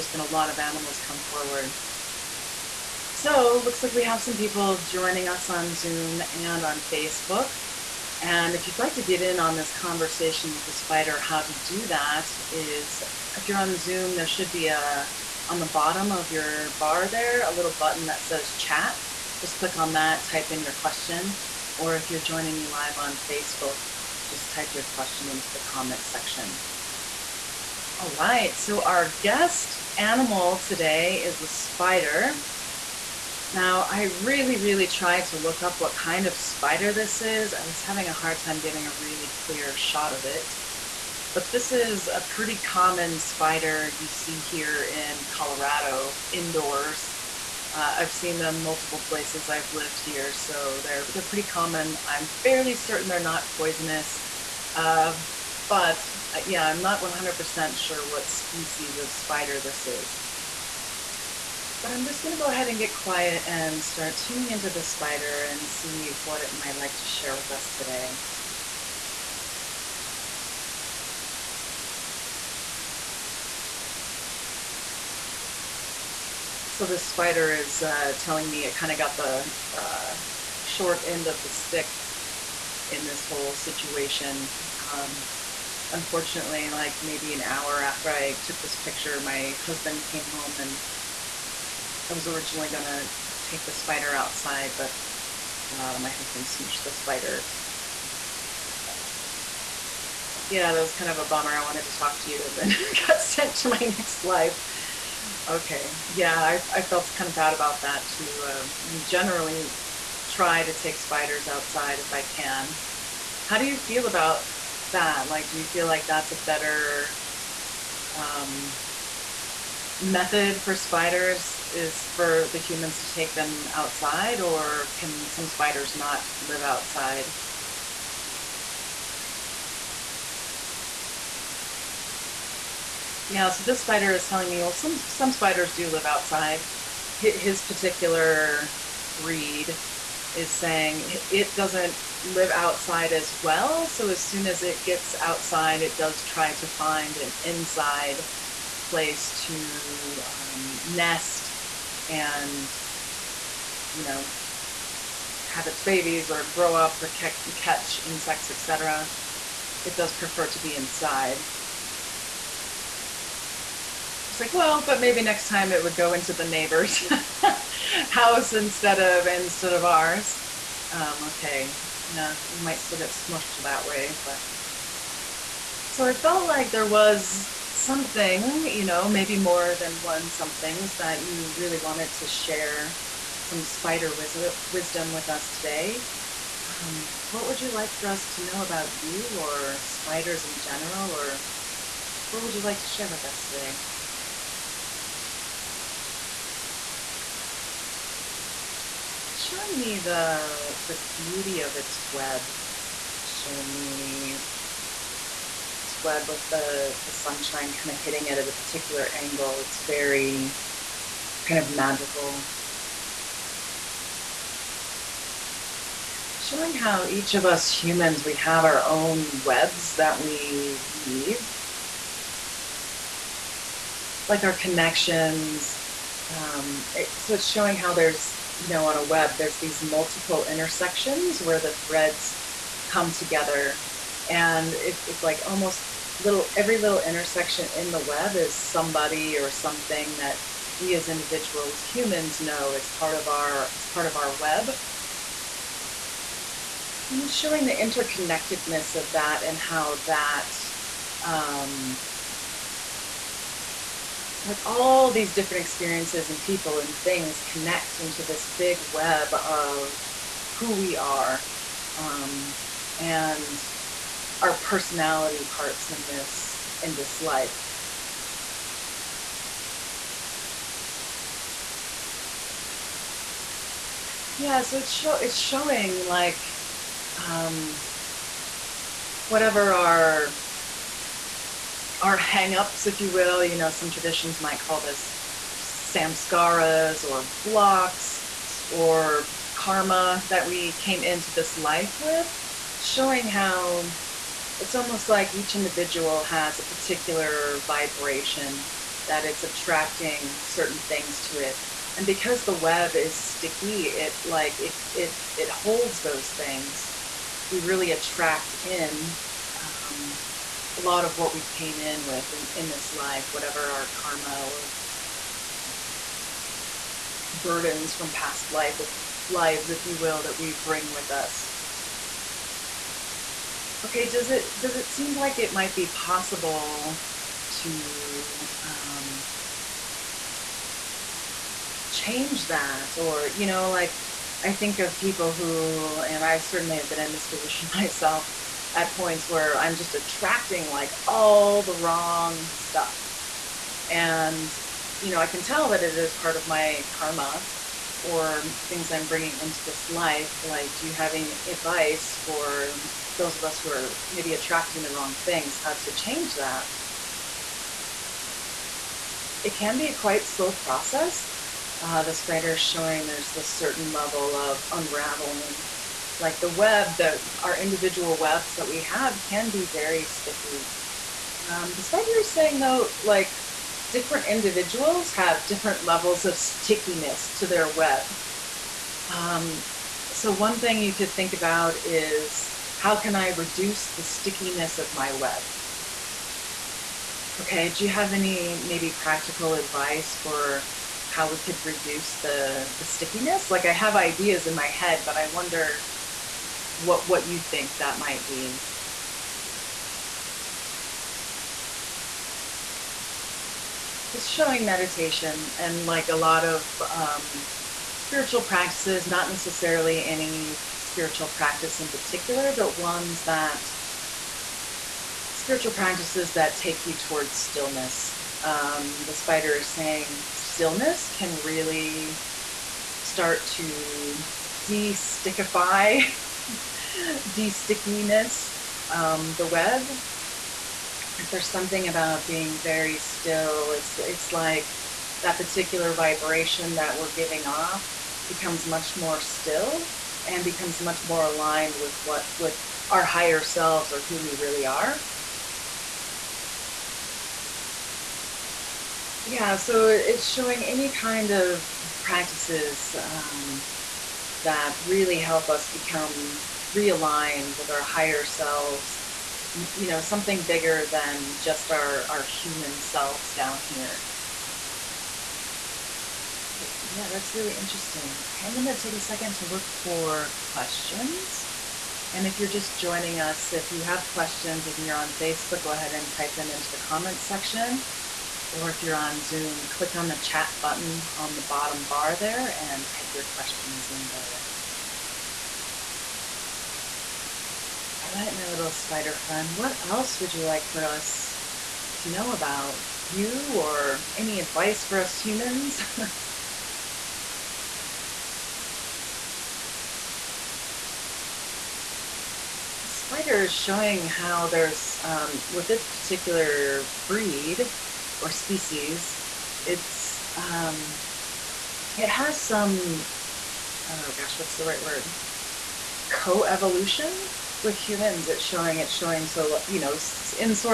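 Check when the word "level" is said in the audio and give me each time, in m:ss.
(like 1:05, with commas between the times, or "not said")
6:03, 6:15.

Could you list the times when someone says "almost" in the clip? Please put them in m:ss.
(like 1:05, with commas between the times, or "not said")
3:55, 4:54.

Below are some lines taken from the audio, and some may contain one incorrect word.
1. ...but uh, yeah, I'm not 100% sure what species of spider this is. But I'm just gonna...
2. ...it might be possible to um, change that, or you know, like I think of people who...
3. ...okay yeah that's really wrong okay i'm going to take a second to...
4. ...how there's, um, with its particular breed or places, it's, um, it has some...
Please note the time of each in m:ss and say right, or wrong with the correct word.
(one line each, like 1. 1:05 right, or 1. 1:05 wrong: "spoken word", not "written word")
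1. 0:55 right
2. 5:25 right
3. 7:46 wrong: "interesting", not "wrong"
4. 8:24 wrong: "species", not "places".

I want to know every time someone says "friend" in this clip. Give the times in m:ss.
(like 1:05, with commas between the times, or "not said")
8:09.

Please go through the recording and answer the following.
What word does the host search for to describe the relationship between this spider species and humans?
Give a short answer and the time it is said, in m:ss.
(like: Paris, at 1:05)
Co-evolution, at 8:36.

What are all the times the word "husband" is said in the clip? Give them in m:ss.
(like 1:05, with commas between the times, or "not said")
1:29, 1:36.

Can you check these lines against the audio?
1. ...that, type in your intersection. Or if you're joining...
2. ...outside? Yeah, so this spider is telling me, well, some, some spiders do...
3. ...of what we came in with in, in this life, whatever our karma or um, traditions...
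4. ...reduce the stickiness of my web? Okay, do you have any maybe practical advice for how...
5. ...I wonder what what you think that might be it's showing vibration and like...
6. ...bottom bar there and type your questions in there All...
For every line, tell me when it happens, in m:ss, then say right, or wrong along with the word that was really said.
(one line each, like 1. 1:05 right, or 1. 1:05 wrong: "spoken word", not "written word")
1. 0:19 wrong: "question", not "intersection"
2. 2:06 right
3. 5:11 wrong: "burdens", not "traditions"
4. 6:23 right
5. 6:35 wrong: "meditation", not "vibration"
6. 8:01 right.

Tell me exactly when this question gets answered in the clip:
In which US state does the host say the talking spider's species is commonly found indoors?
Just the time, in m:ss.
0:45.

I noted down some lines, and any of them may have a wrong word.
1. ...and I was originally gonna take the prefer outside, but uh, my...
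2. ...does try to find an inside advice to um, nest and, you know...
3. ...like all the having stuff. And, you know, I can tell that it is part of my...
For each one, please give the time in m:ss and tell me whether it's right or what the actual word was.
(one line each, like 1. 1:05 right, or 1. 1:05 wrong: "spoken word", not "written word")
1. 1:30 wrong: "spider", not "prefer"
2. 2:25 wrong: "place", not "advice"
3. 5:40 wrong: "wrong", not "having".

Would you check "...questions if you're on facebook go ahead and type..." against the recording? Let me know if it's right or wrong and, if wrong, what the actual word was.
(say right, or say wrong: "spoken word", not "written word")
right.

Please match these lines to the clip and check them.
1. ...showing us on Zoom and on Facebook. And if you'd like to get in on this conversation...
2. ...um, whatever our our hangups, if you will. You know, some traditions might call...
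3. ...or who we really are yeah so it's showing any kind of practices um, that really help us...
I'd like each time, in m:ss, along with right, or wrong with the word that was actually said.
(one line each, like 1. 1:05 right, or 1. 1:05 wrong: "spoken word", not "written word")
1. 0:04 wrong: "joining", not "showing"
2. 4:37 right
3. 7:23 right.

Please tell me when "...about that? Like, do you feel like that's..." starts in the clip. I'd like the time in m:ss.
1:54.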